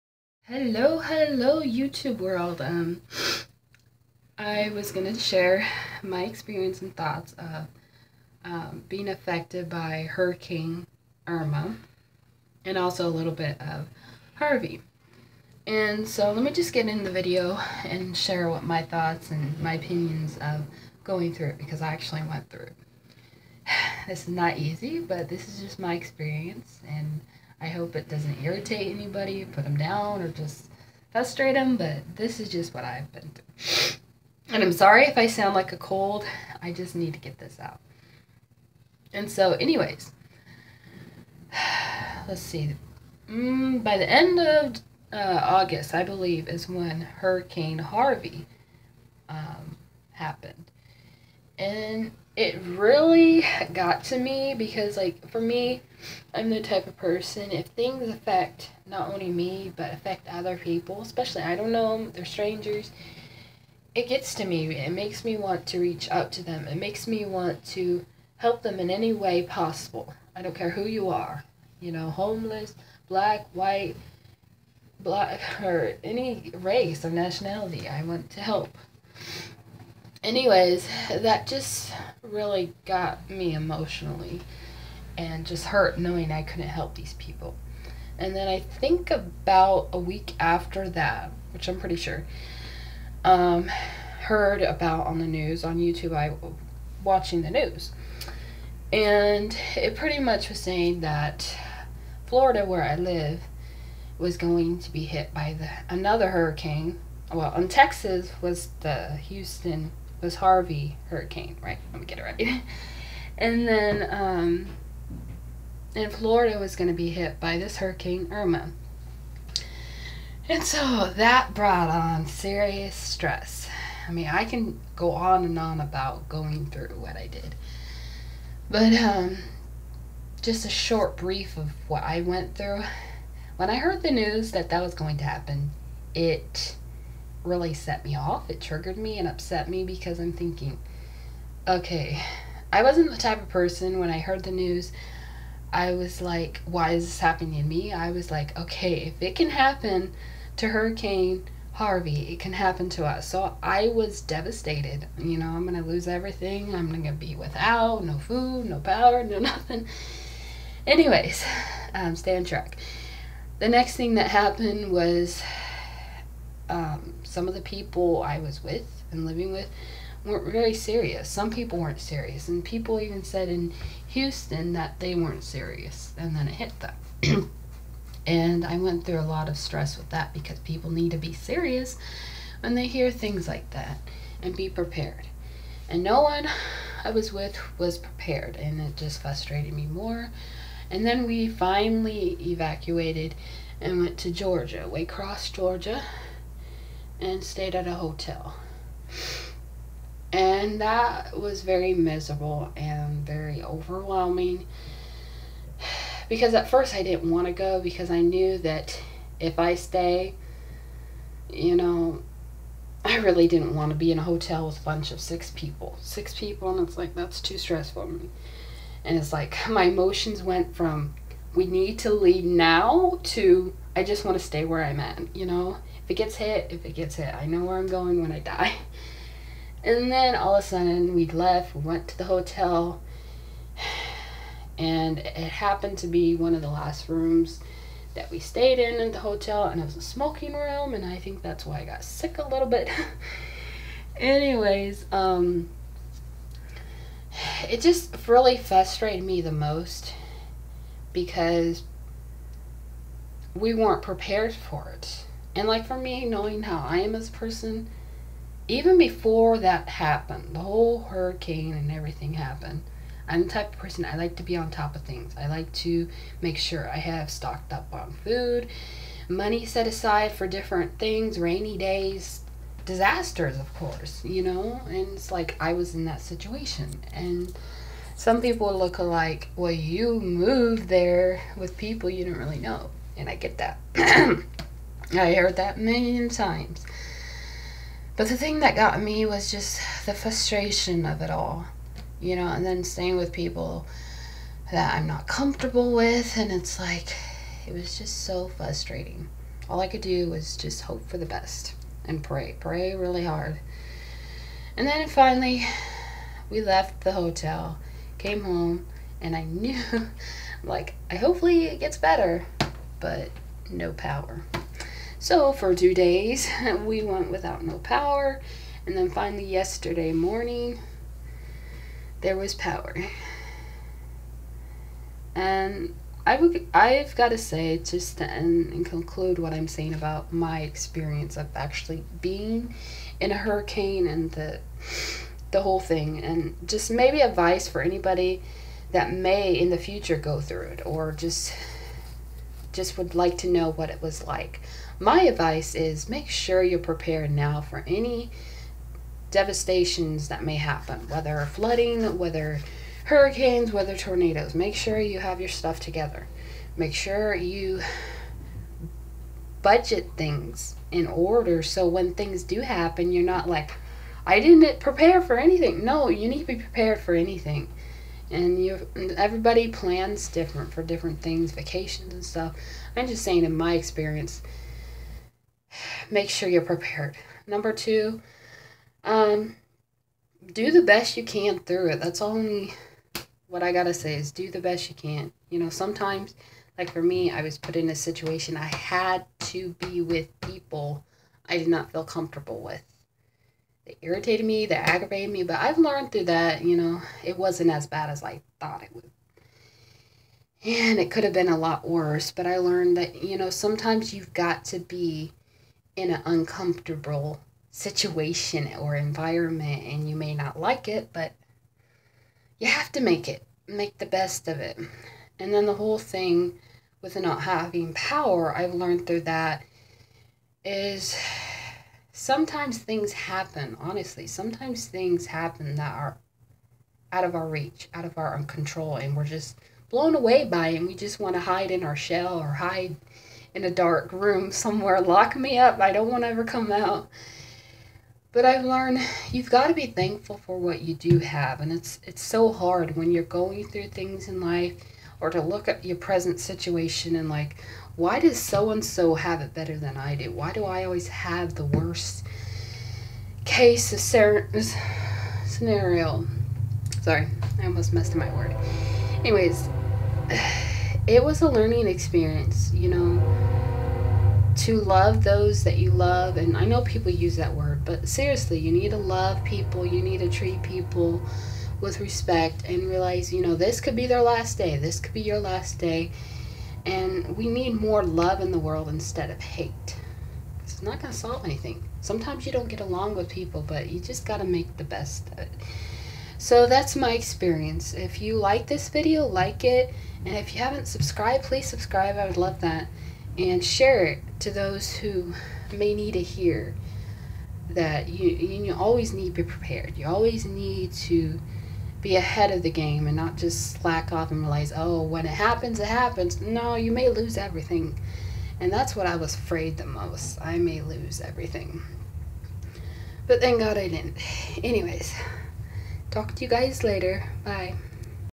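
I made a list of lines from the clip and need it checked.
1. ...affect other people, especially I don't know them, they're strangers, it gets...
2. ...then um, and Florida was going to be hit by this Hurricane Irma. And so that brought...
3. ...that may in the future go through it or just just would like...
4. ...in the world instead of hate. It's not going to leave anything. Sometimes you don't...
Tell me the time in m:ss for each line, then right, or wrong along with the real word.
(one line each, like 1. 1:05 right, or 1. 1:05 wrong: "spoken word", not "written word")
1. 0:59 right
2. 1:53 right
3. 5:38 right
4. 7:58 wrong: "solve", not "leave".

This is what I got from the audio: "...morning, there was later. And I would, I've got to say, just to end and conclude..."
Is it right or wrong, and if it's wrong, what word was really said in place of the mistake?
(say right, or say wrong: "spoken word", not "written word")
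wrong: "power", not "later".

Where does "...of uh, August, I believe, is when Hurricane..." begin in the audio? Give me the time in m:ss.
0:44.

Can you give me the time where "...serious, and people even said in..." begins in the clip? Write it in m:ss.
2:51.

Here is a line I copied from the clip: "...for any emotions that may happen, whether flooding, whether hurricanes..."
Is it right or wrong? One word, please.
wrong.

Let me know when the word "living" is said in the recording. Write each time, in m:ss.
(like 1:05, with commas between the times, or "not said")
2:49.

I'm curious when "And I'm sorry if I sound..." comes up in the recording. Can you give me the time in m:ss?
0:34.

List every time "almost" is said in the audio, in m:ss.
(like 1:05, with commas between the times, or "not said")
7:37.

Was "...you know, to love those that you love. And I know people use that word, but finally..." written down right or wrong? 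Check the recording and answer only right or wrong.
wrong.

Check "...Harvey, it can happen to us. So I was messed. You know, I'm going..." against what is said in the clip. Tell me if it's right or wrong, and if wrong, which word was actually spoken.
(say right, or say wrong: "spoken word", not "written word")
wrong: "devastated", not "messed".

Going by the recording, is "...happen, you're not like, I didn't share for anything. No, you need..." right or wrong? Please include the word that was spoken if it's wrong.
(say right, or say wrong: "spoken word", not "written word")
wrong: "prepare", not "share".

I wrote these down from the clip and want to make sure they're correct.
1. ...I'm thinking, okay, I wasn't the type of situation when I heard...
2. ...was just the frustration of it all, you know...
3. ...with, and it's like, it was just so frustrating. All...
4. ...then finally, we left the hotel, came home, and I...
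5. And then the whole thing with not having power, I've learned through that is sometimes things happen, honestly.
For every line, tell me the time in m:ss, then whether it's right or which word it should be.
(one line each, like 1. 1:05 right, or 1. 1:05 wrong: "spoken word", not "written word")
1. 2:20 wrong: "person", not "situation"
2. 4:49 right
3. 4:55 right
4. 5:04 right
5. 6:55 right.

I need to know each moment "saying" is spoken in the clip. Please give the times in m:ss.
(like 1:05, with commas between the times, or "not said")
1:40, 5:29, 6:13.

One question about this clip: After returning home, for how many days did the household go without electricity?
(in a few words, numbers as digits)
2.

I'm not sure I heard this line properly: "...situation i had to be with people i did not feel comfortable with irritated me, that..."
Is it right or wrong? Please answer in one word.
right.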